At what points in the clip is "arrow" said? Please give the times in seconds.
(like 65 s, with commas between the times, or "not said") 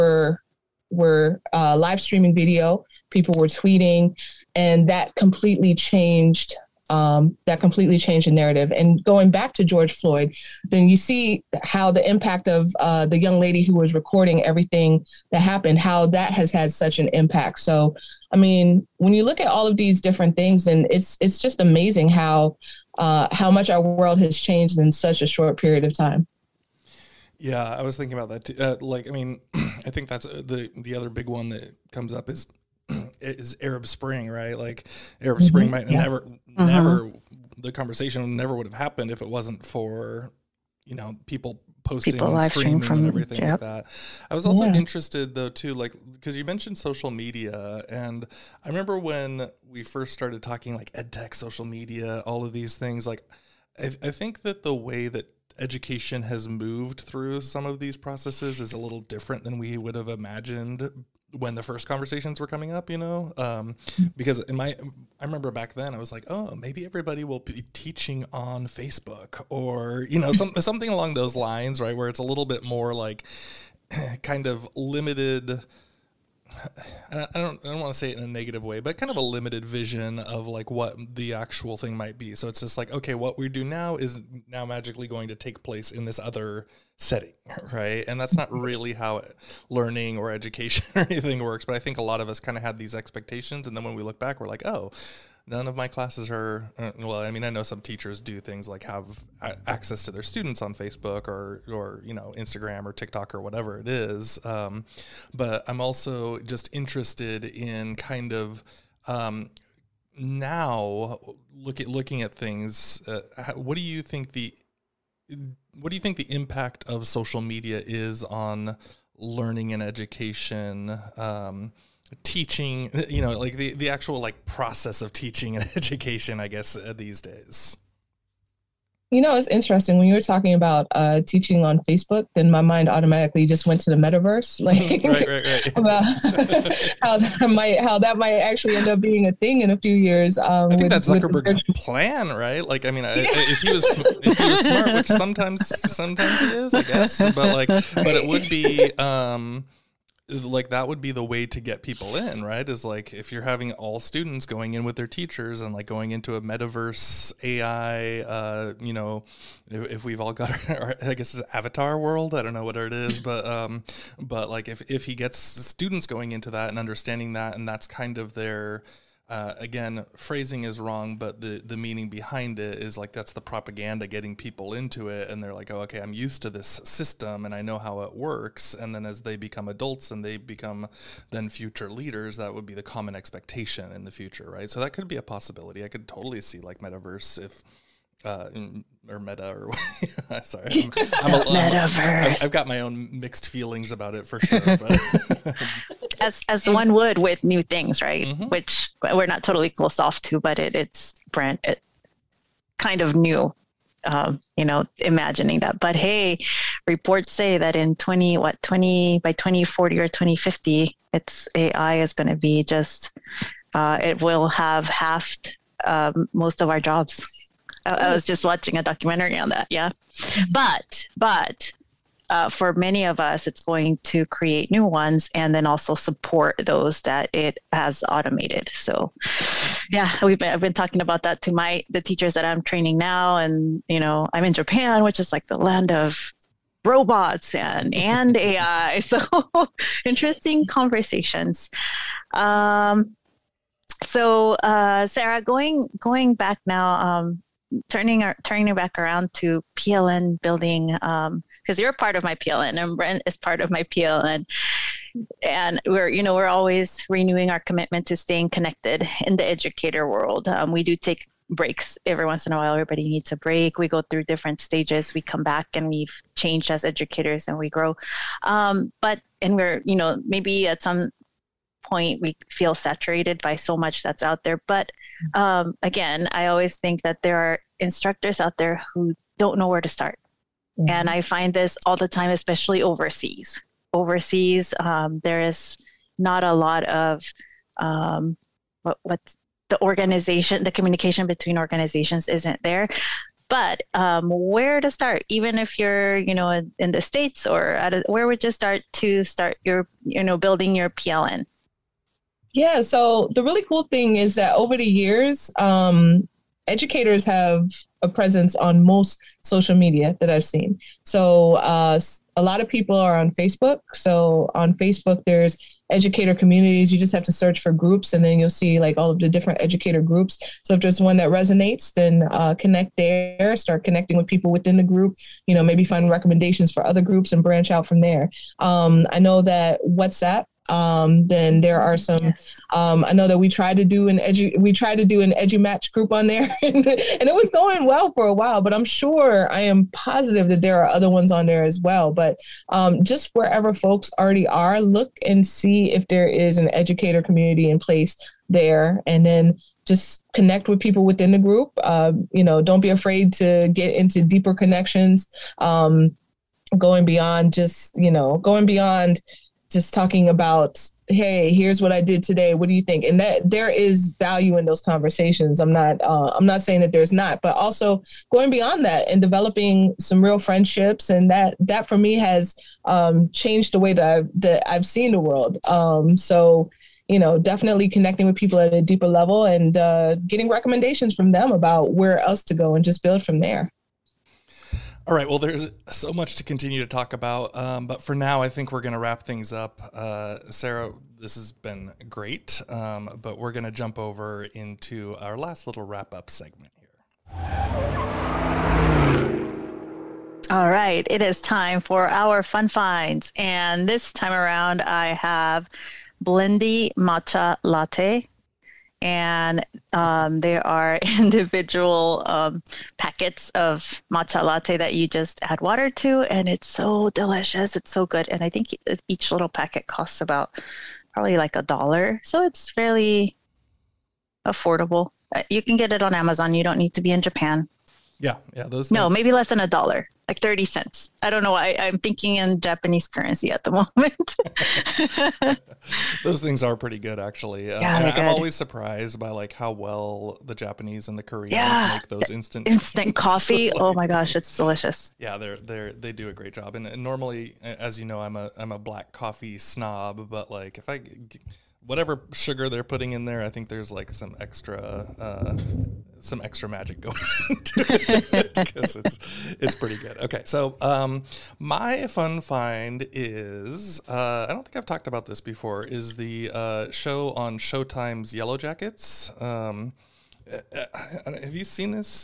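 not said.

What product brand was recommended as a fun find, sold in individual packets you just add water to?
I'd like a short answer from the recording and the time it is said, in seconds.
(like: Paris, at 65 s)
Blendy, at 406 s.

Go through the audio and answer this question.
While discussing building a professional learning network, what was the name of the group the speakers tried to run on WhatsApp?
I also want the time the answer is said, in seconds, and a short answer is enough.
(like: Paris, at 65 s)
EduMatch, at 335 s.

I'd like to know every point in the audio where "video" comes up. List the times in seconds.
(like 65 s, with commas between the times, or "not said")
2 s.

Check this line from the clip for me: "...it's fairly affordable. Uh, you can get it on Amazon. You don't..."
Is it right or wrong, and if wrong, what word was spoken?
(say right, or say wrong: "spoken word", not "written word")
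right.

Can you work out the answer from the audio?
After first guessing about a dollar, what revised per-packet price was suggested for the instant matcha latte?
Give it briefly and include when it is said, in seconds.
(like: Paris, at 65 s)
30 cents, at 430 s.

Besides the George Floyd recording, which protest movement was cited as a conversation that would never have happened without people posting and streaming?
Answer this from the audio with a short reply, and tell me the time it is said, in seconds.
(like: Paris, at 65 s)
Arab Spring, at 33 s.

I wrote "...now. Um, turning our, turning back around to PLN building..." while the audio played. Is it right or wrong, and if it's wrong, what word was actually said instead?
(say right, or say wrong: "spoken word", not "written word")
right.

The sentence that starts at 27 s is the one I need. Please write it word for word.
Yeah, I was thinking about that too.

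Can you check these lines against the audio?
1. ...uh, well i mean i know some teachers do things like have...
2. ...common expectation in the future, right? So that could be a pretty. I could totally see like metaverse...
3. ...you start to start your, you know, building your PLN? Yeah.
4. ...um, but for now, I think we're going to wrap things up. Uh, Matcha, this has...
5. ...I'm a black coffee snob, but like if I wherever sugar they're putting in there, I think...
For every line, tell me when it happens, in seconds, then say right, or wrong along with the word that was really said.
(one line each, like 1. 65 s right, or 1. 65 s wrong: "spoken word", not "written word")
1. 96 s right
2. 182 s wrong: "possibility", not "pretty"
3. 298 s right
4. 387 s wrong: "Sarah", not "Matcha"
5. 448 s wrong: "whatever", not "wherever".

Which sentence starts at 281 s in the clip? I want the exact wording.
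find this all the time, especially overseas.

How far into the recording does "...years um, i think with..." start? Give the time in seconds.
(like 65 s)
139 s.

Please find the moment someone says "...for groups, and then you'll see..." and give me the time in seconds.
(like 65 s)
317 s.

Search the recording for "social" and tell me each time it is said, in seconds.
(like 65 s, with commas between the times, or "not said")
46 s, 51 s, 117 s, 309 s.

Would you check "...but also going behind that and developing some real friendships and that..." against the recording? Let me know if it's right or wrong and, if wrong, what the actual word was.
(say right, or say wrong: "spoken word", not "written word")
wrong: "beyond", not "behind".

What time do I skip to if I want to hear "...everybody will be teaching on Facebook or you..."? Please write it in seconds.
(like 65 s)
66 s.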